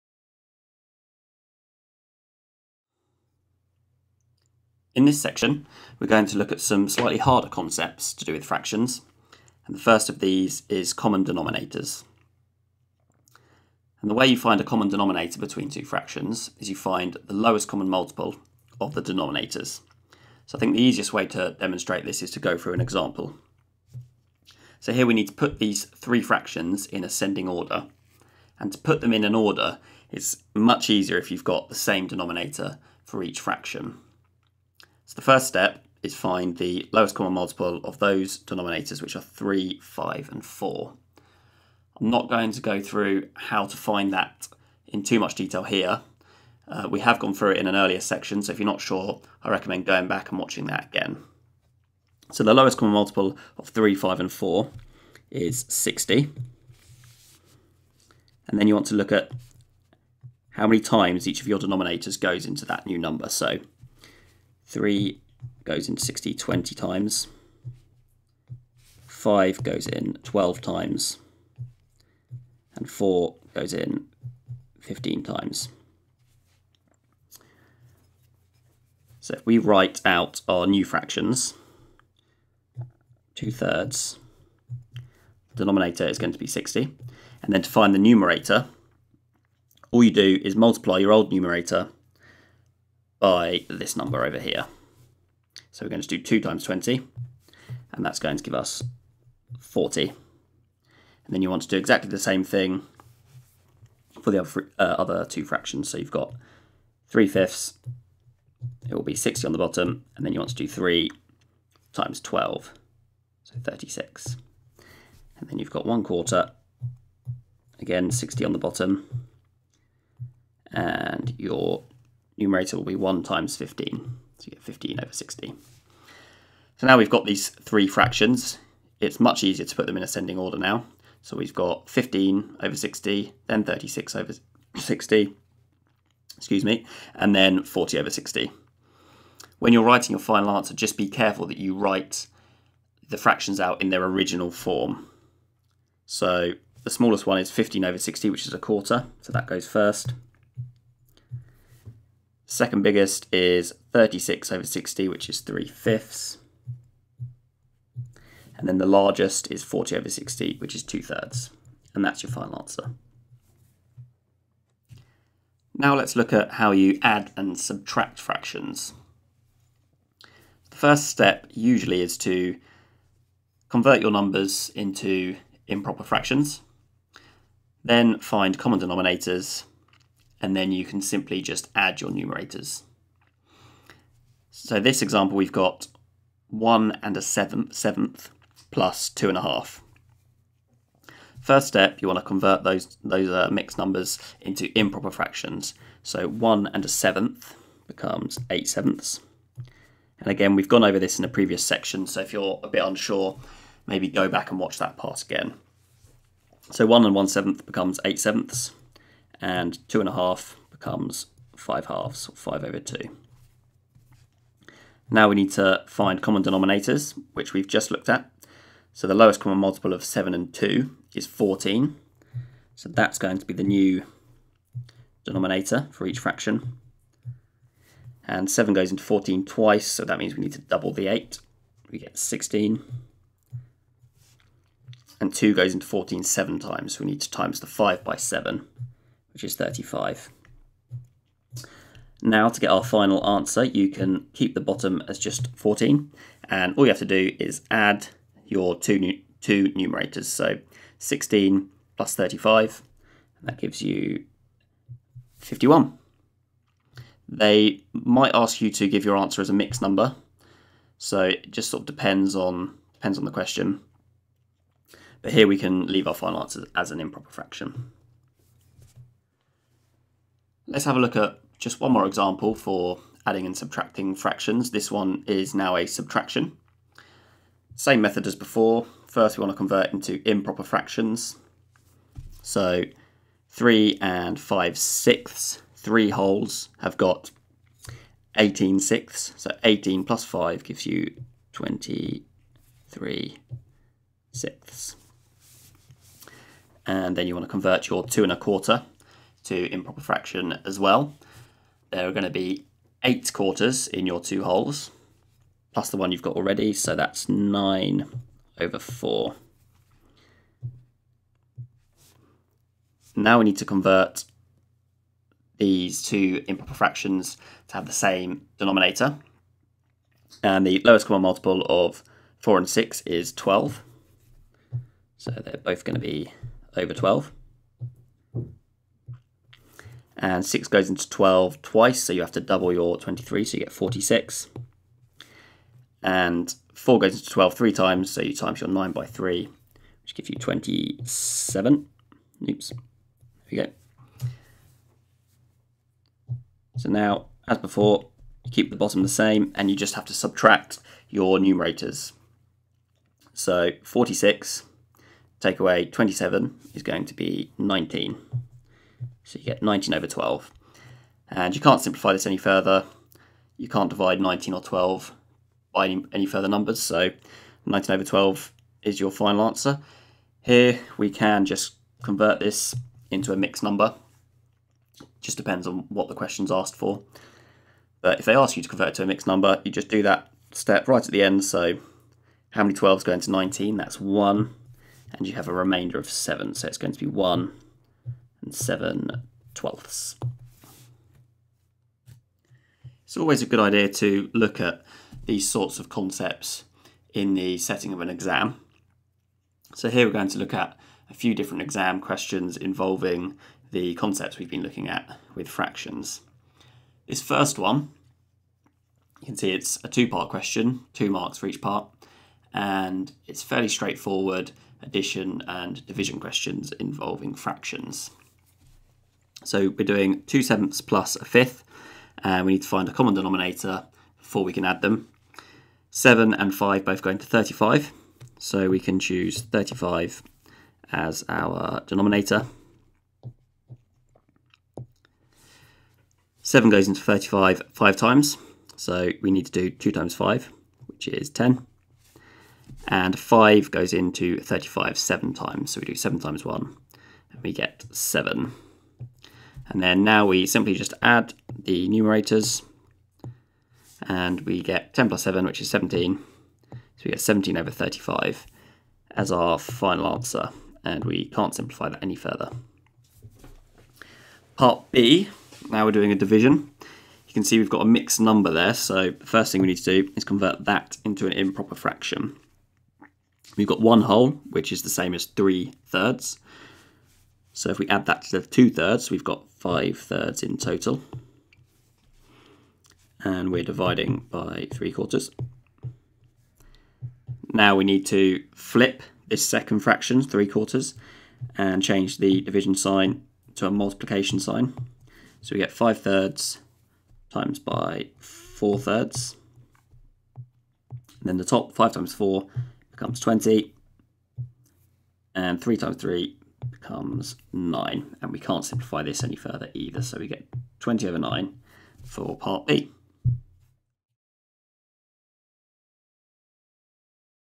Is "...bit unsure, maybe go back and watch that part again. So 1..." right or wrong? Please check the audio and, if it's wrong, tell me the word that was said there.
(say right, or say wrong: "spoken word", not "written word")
right.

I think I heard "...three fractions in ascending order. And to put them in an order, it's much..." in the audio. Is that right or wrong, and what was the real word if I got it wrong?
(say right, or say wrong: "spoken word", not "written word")
right.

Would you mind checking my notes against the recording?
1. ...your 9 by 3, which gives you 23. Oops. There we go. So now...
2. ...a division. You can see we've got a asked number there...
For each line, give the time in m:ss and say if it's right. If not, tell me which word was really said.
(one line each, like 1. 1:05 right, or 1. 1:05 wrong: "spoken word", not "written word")
1. 5:38 wrong: "27", not "23"
2. 7:46 wrong: "mixed", not "asked".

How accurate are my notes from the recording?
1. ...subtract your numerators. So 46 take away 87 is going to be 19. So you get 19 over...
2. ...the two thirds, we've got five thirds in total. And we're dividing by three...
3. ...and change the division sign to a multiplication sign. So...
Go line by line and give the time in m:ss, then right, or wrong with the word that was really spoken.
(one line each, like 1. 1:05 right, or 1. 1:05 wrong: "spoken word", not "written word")
1. 5:50 wrong: "27", not "87"
2. 7:58 right
3. 8:11 right.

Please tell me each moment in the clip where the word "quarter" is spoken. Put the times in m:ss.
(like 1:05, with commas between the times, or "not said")
1:56, 2:28, 4:58, 5:03, 8:04, 8:10.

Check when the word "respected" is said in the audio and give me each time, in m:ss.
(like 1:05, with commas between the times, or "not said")
not said.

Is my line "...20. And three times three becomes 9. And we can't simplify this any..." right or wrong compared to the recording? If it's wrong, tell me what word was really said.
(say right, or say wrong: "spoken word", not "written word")
right.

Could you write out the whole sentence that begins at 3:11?
First step, you want to convert those, those uh, mixed numbers into improper fractions.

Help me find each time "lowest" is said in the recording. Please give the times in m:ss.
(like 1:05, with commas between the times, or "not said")
0:17, 0:36, 0:52, 3:39, 5:20.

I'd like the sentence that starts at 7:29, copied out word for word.
And then now we simply just add the numerators and we get 10 plus 7, which is 17.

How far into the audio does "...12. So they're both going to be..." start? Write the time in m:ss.
5:23.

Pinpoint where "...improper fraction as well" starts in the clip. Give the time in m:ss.
4:59.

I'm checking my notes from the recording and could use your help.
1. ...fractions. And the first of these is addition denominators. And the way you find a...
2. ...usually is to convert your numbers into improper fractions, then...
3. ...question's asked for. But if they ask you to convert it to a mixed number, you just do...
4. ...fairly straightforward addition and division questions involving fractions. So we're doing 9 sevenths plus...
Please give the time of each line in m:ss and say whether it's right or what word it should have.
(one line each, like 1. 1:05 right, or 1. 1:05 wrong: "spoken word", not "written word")
1. 0:08 wrong: "common", not "addition"
2. 2:51 right
3. 6:16 right
4. 6:53 wrong: "2", not "9".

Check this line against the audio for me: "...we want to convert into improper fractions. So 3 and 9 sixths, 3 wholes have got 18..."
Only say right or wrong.
wrong.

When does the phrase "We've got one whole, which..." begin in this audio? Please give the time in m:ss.
7:53.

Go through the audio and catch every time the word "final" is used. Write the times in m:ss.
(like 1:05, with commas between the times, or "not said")
2:20, 2:42, 4:02, 4:26, 6:09, 7:39.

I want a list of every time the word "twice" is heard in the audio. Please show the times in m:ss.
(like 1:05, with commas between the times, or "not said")
3:49, 5:31.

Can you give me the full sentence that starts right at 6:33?
It's always a good idea to look at these sorts of concepts in the setting of an exam.